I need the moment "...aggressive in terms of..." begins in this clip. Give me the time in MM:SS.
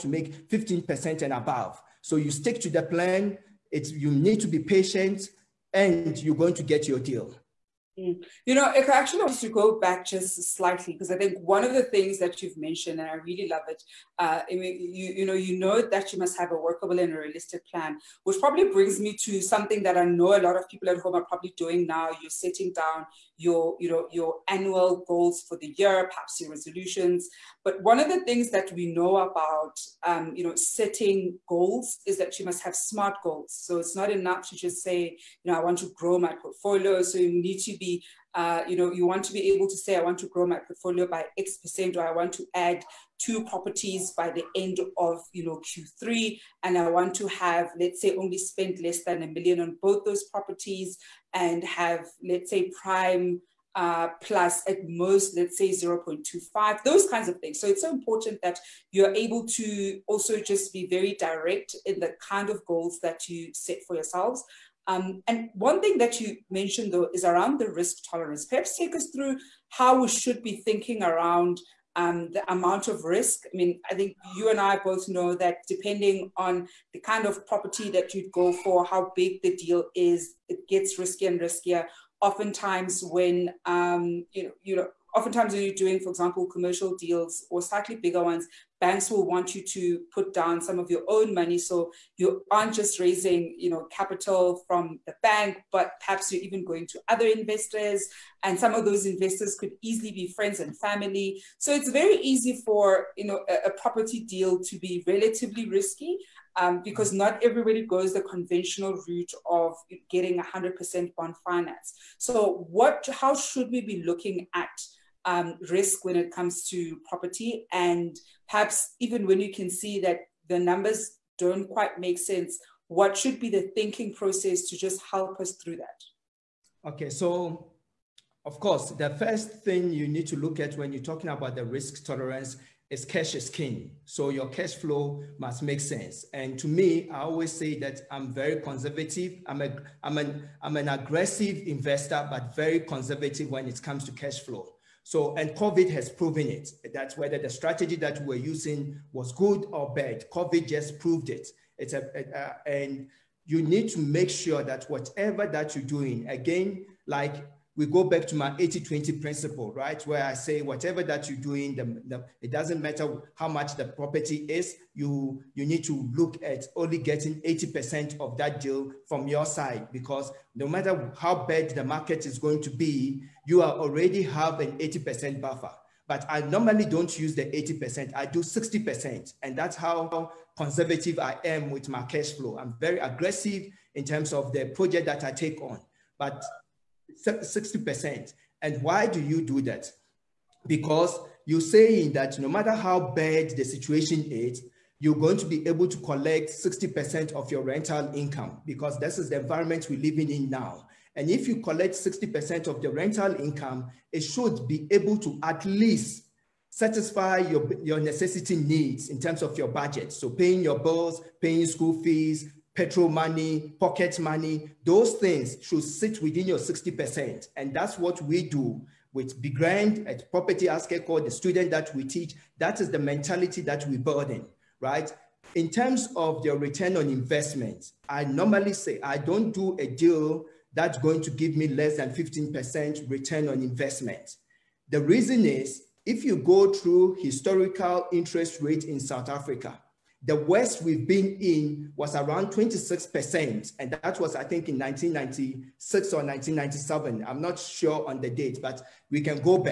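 03:02.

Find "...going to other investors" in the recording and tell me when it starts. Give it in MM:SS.
01:36.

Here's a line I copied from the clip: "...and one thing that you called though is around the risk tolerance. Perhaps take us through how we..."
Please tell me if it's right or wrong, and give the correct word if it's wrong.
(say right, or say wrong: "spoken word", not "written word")
wrong: "mentioned", not "called".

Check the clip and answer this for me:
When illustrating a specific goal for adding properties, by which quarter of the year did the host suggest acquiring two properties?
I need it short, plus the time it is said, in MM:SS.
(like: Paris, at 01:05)
Q3, at 00:45.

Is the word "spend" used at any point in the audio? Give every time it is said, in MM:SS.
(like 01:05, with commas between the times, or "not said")
00:48.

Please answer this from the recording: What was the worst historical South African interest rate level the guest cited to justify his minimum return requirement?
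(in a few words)
26%.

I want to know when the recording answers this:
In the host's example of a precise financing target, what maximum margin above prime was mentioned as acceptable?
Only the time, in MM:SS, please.
00:55.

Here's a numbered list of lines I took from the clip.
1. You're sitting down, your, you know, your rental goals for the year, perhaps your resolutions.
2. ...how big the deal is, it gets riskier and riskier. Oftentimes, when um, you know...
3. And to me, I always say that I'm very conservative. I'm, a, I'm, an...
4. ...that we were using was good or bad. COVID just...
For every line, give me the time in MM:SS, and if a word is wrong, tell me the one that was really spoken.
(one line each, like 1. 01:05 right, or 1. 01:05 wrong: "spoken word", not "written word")
1. 00:22 wrong: "annual", not "rental"
2. 01:18 right
3. 02:16 right
4. 02:27 right.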